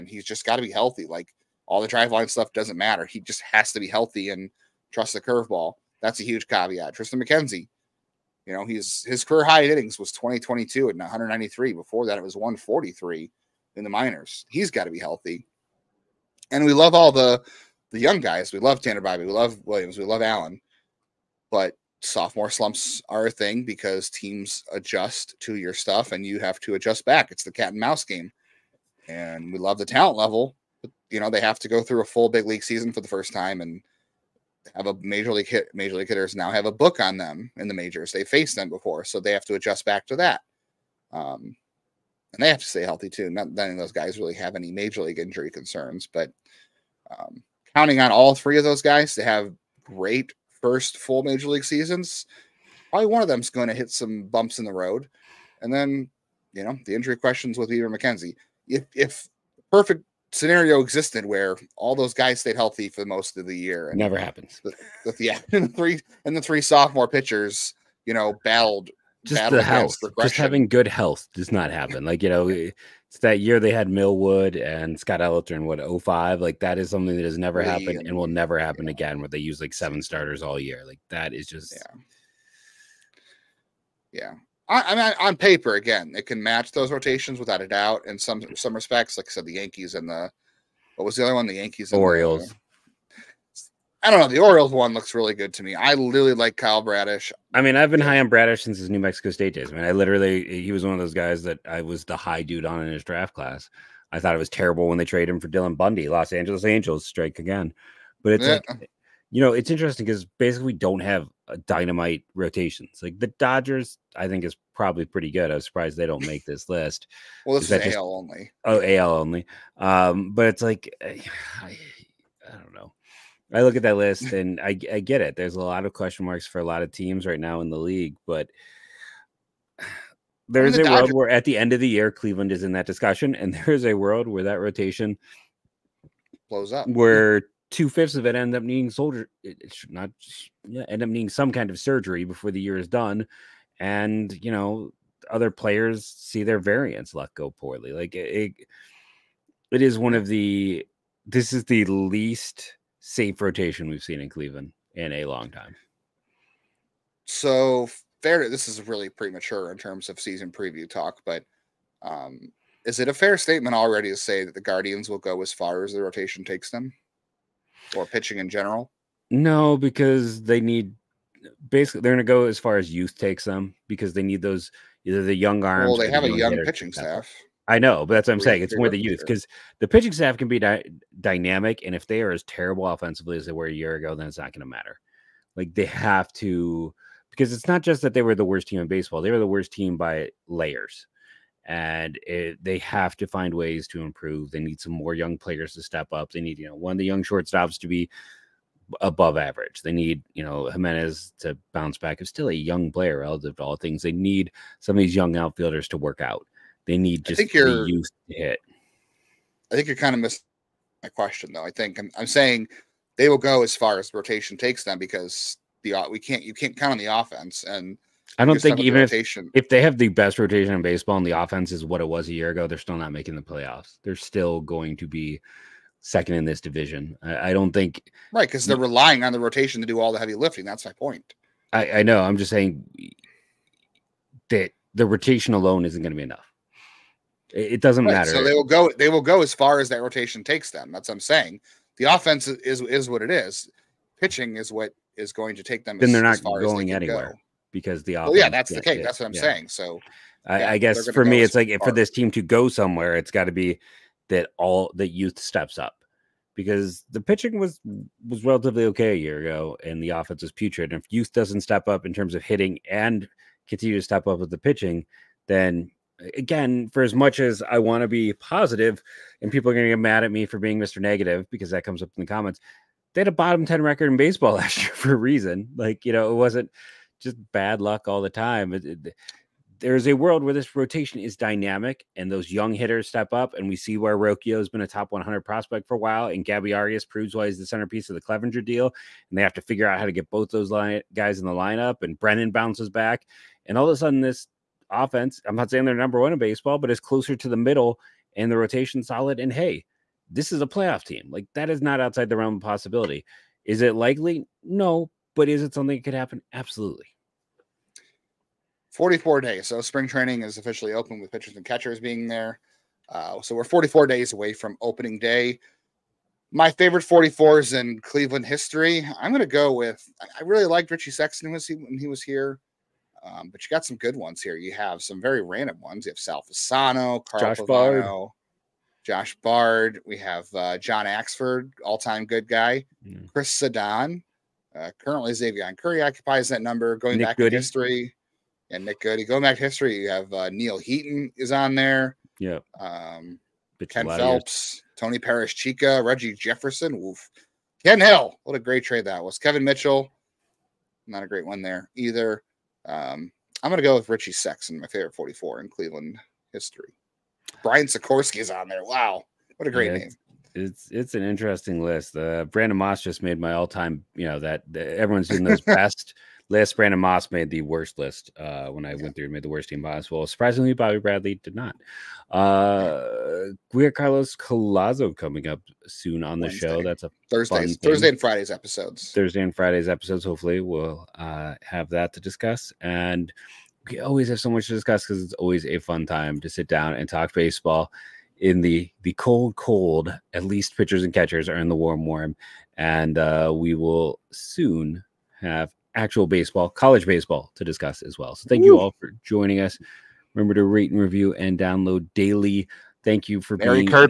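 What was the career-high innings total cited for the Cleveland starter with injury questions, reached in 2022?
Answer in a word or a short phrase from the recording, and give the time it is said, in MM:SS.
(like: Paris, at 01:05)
193, at 00:10.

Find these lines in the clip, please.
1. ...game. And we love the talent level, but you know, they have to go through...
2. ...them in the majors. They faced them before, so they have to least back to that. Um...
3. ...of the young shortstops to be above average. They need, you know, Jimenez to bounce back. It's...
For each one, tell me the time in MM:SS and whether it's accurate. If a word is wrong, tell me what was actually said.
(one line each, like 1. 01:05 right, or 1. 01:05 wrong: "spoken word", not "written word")
1. 00:28 right
2. 00:37 wrong: "adjust", not "least"
3. 03:16 right.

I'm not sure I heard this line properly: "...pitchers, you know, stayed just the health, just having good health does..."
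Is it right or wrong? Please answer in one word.
wrong.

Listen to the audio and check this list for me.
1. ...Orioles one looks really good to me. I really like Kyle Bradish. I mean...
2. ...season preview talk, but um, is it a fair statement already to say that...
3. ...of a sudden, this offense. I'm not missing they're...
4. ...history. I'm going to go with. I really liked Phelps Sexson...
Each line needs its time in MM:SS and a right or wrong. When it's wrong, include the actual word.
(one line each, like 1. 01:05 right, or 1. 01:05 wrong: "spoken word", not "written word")
1. 01:34 right
2. 02:40 right
3. 04:53 wrong: "saying", not "missing"
4. 05:18 wrong: "Richie", not "Phelps".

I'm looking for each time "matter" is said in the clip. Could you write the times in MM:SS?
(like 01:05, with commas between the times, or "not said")
00:02, 03:04, 03:58.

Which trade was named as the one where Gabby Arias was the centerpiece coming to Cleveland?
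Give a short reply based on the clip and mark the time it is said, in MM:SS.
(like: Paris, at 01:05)
Clevinger deal, at 04:48.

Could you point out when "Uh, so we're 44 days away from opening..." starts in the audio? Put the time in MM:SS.
05:13.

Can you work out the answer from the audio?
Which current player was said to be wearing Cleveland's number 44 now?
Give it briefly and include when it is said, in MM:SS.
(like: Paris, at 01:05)
Xavier Curry, at 05:35.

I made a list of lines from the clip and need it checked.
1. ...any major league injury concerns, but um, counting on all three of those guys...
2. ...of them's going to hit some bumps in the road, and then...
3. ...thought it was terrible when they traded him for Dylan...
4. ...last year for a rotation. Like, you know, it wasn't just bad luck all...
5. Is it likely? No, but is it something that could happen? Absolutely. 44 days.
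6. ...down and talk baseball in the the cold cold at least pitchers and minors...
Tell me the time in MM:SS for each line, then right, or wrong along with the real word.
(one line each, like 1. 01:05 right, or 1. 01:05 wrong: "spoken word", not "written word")
1. 00:44 right
2. 00:53 right
3. 01:44 right
4. 04:34 wrong: "reason", not "rotation"
5. 05:03 right
6. 06:26 wrong: "catchers", not "minors".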